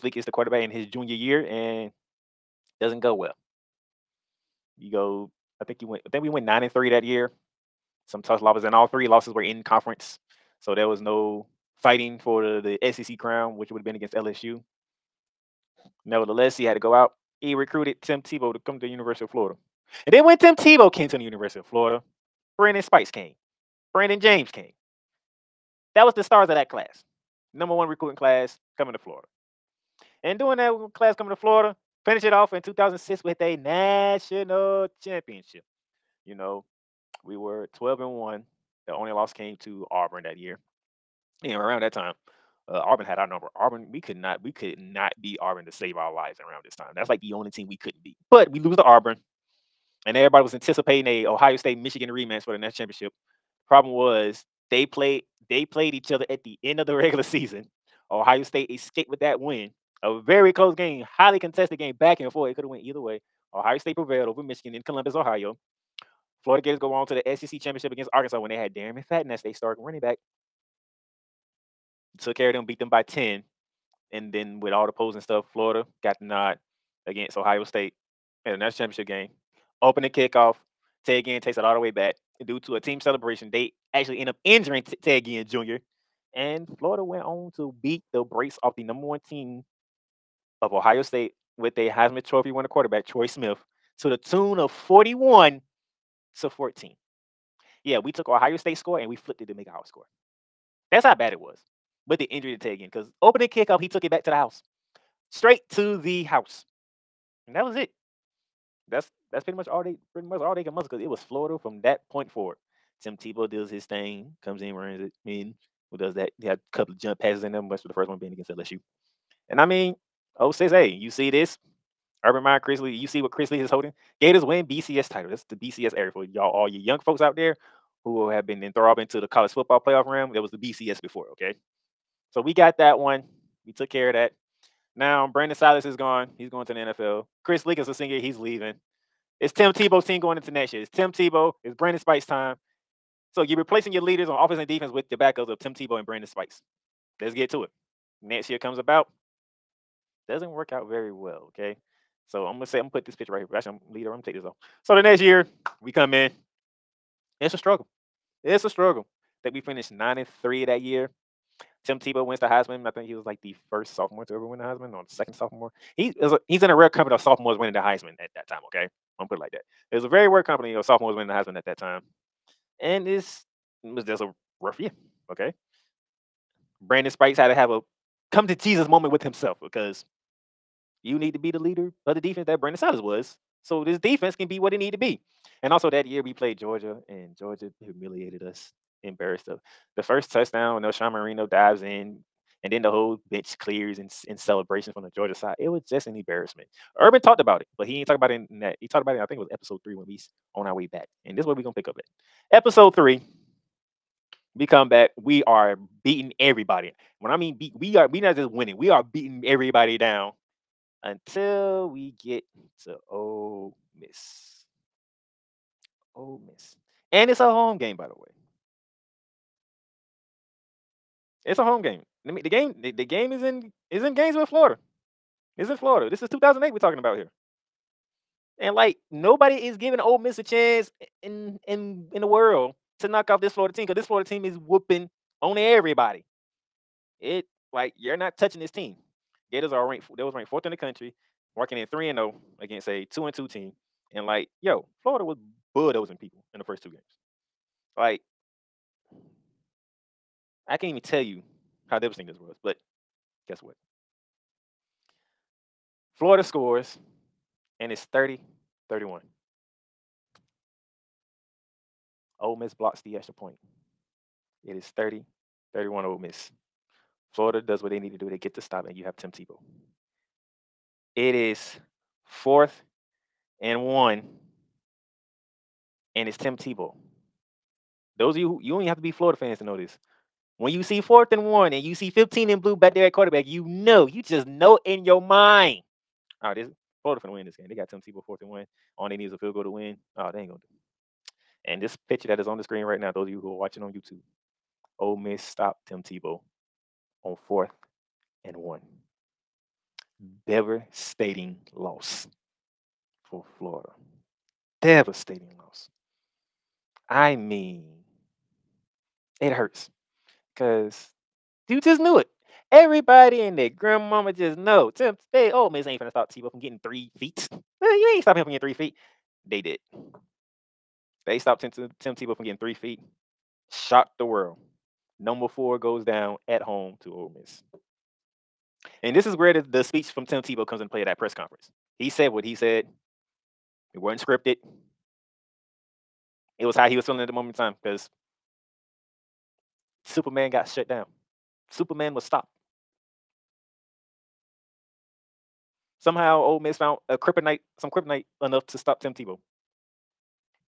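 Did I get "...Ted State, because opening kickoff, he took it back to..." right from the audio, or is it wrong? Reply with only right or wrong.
wrong.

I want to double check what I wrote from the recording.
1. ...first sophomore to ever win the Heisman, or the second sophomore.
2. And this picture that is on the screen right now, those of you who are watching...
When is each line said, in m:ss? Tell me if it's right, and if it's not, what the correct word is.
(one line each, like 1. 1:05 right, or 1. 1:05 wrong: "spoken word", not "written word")
1. 2:43 right
2. 4:51 right.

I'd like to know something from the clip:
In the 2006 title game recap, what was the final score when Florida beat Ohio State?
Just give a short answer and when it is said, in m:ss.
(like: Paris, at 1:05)
41 to 14, at 1:34.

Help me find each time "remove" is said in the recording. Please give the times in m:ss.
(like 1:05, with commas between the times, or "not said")
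not said.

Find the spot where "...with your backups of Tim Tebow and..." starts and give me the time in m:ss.
2:24.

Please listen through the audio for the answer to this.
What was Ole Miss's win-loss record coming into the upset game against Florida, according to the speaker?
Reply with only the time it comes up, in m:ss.
4:03.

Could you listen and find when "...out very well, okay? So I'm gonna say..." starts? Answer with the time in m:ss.
2:30.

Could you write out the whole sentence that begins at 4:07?
Like, I can't even tell you how devastating this was, but guess what?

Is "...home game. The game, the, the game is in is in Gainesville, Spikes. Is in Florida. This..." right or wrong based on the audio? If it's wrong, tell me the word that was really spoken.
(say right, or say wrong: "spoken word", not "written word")
wrong: "Florida", not "Spikes".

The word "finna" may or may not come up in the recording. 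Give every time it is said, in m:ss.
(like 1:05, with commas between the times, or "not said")
4:47, 5:15.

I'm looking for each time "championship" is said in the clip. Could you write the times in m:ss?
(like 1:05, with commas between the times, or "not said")
0:34, 0:52, 1:07, 1:18.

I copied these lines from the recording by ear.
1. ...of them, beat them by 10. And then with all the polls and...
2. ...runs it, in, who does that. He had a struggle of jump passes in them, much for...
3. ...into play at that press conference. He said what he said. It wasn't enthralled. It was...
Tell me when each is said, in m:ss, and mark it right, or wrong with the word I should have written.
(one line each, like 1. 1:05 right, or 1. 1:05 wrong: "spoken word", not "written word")
1. 1:12 right
2. 1:54 wrong: "couple", not "struggle"
3. 5:30 wrong: "scripted", not "enthralled".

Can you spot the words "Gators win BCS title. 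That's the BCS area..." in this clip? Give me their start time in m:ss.
2:04.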